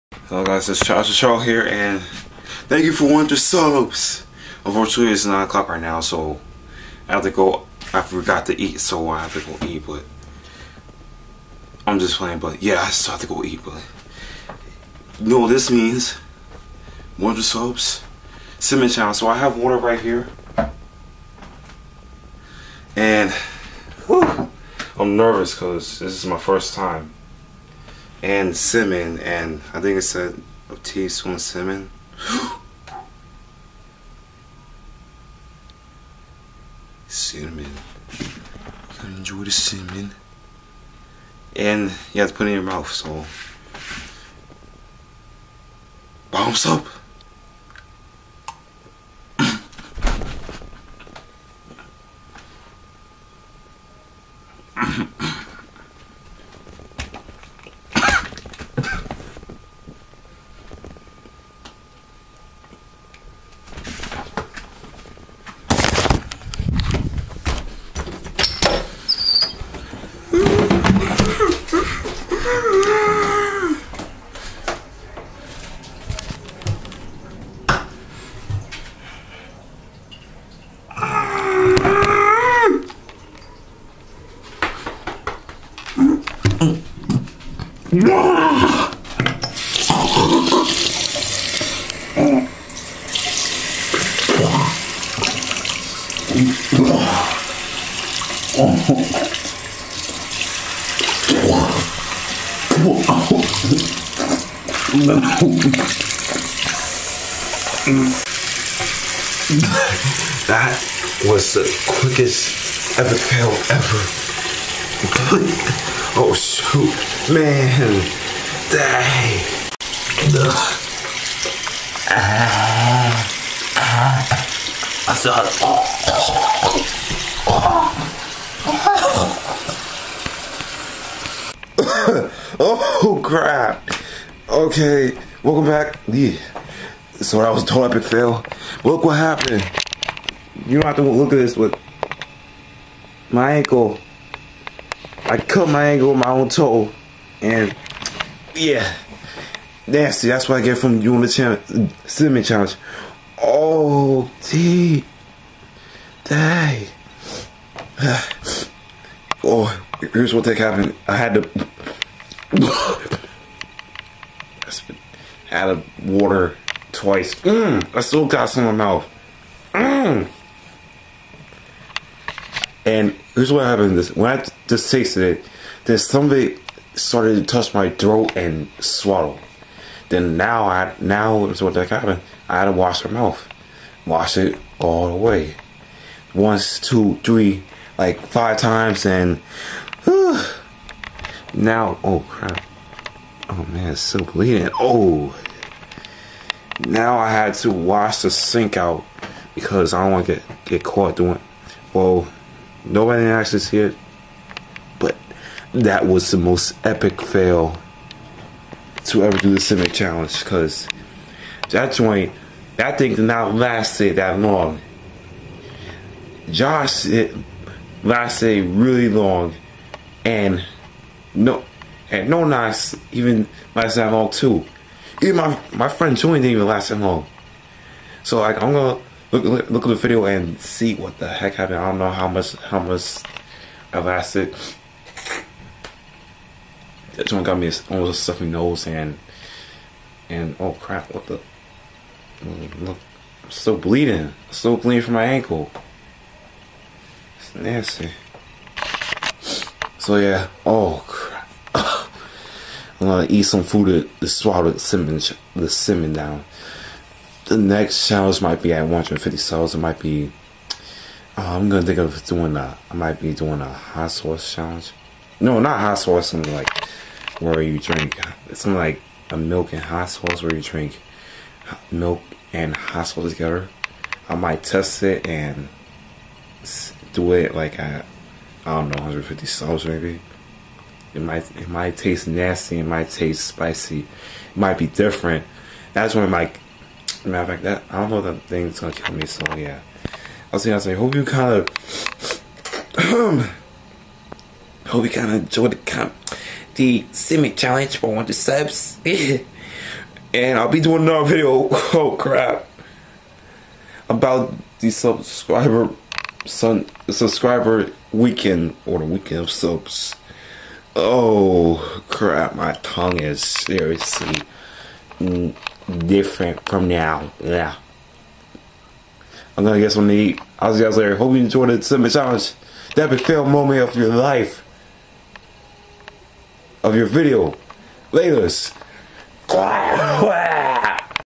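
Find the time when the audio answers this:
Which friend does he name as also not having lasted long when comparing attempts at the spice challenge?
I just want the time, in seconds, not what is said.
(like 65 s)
226 s.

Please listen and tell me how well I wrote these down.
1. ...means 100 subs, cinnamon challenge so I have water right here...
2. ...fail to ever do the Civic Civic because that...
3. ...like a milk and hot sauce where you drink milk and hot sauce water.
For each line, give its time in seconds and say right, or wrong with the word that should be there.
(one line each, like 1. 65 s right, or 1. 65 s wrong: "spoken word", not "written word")
1. 15 s right
2. 207 s wrong: "Challenge", not "Civic"
3. 268 s wrong: "together", not "water".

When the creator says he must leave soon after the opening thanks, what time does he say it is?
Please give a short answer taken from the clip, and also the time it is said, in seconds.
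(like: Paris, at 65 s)
9 o'clock, at 5 s.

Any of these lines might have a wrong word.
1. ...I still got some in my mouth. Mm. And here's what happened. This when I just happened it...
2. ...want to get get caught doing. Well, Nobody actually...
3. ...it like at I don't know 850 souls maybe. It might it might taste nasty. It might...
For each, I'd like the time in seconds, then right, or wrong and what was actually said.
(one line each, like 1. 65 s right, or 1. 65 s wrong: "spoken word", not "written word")
1. 167 s wrong: "tasted", not "happened"
2. 200 s right
3. 277 s wrong: "150", not "850".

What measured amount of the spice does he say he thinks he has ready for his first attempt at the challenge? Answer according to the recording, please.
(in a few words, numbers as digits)
a teaspoon.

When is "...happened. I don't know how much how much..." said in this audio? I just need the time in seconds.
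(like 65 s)
231 s.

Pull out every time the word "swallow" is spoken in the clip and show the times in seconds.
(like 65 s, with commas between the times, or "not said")
178 s, 254 s.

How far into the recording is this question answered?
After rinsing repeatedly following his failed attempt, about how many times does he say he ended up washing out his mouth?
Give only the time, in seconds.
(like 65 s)
188 s.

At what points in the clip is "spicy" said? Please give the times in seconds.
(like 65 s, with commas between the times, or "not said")
283 s.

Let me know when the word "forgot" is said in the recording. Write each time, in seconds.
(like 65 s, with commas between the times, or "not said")
8 s.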